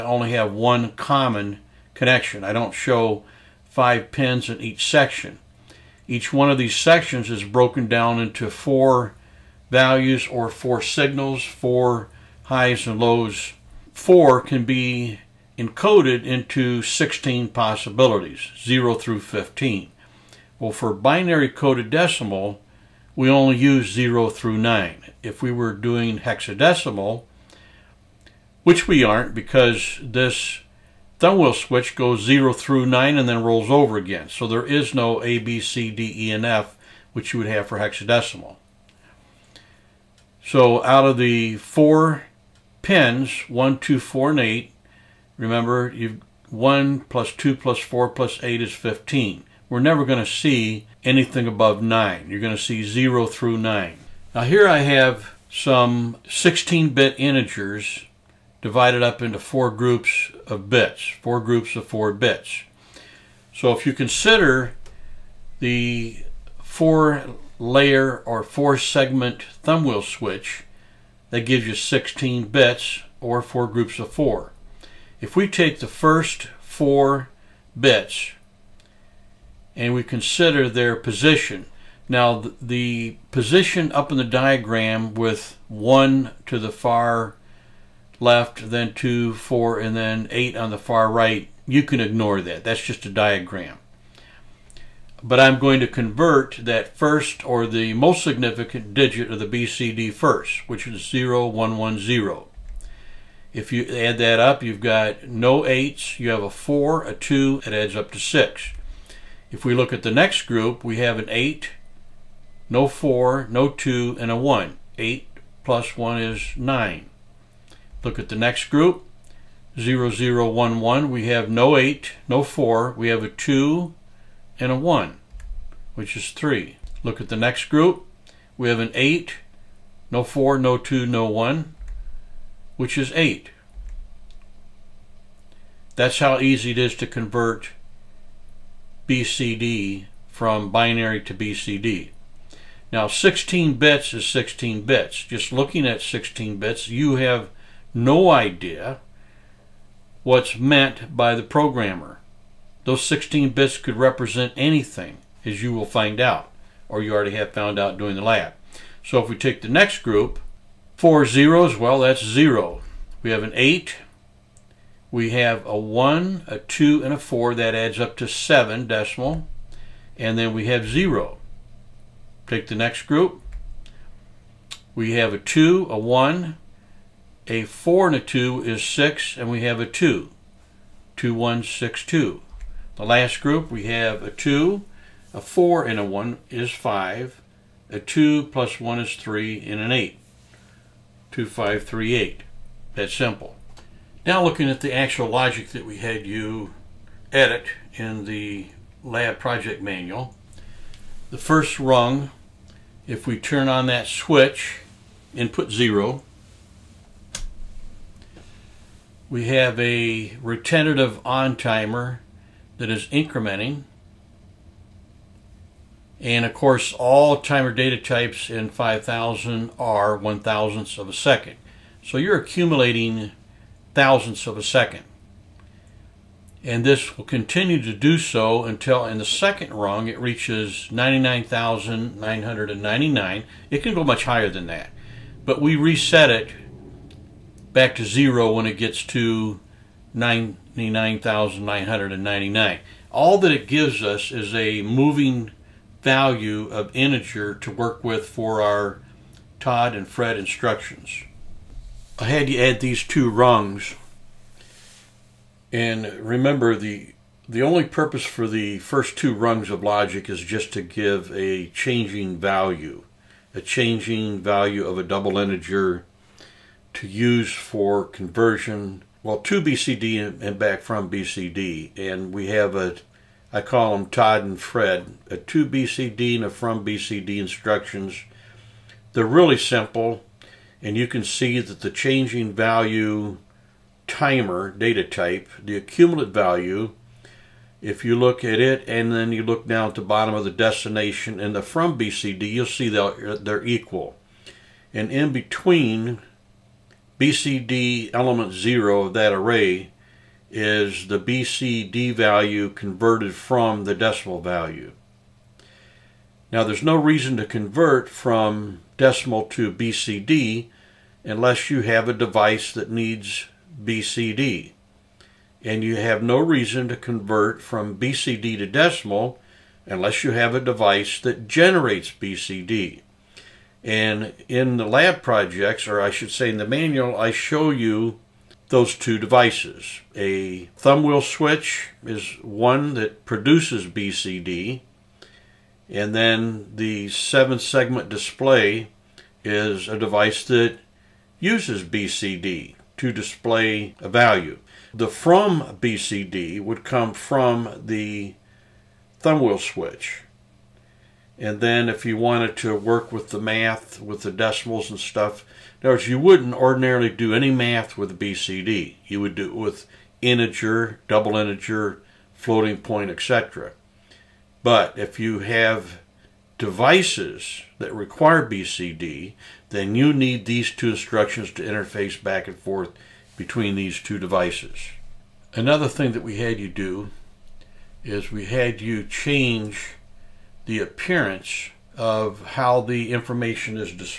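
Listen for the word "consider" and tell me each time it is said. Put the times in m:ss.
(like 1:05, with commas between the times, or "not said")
1:03, 1:20.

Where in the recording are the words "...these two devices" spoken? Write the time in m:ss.
6:13.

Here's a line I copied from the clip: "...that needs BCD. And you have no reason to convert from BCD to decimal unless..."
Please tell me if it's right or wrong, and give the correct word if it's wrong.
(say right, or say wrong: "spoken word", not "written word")
right.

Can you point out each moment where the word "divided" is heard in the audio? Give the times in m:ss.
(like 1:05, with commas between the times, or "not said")
0:58.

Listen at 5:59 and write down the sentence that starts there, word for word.
You would do it with integer, double integer, floating point, etc.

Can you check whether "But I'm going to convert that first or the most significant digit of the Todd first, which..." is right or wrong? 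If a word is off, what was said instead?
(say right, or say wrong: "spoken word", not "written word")
wrong: "BCD", not "Todd".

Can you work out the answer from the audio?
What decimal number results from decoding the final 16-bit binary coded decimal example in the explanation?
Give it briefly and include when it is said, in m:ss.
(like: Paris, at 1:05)
2538, at 3:11.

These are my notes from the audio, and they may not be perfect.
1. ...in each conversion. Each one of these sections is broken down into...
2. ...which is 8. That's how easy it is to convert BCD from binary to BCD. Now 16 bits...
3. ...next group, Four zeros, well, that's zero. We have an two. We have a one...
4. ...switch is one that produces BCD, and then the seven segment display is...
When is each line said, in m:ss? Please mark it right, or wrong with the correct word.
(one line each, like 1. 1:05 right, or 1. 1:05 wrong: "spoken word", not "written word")
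1. 0:04 wrong: "section", not "conversion"
2. 2:12 right
3. 2:39 wrong: "eight", not "two"
4. 5:31 right.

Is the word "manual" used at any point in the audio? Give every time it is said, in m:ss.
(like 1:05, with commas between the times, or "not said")
3:19, 5:26.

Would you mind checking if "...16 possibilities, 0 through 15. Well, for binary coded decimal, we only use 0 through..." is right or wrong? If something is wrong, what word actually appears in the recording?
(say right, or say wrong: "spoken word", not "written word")
right.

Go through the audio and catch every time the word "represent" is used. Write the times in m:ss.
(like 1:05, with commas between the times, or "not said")
2:33.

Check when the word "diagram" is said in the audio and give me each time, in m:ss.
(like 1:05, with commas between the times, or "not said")
1:24, 1:33.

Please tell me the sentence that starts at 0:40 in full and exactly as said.
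So out of the four pins, 1, 2, 4, and 8, Remember, you've 1 plus 2 plus 4 plus 8 is 15.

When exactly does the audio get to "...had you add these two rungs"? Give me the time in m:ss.
4:12.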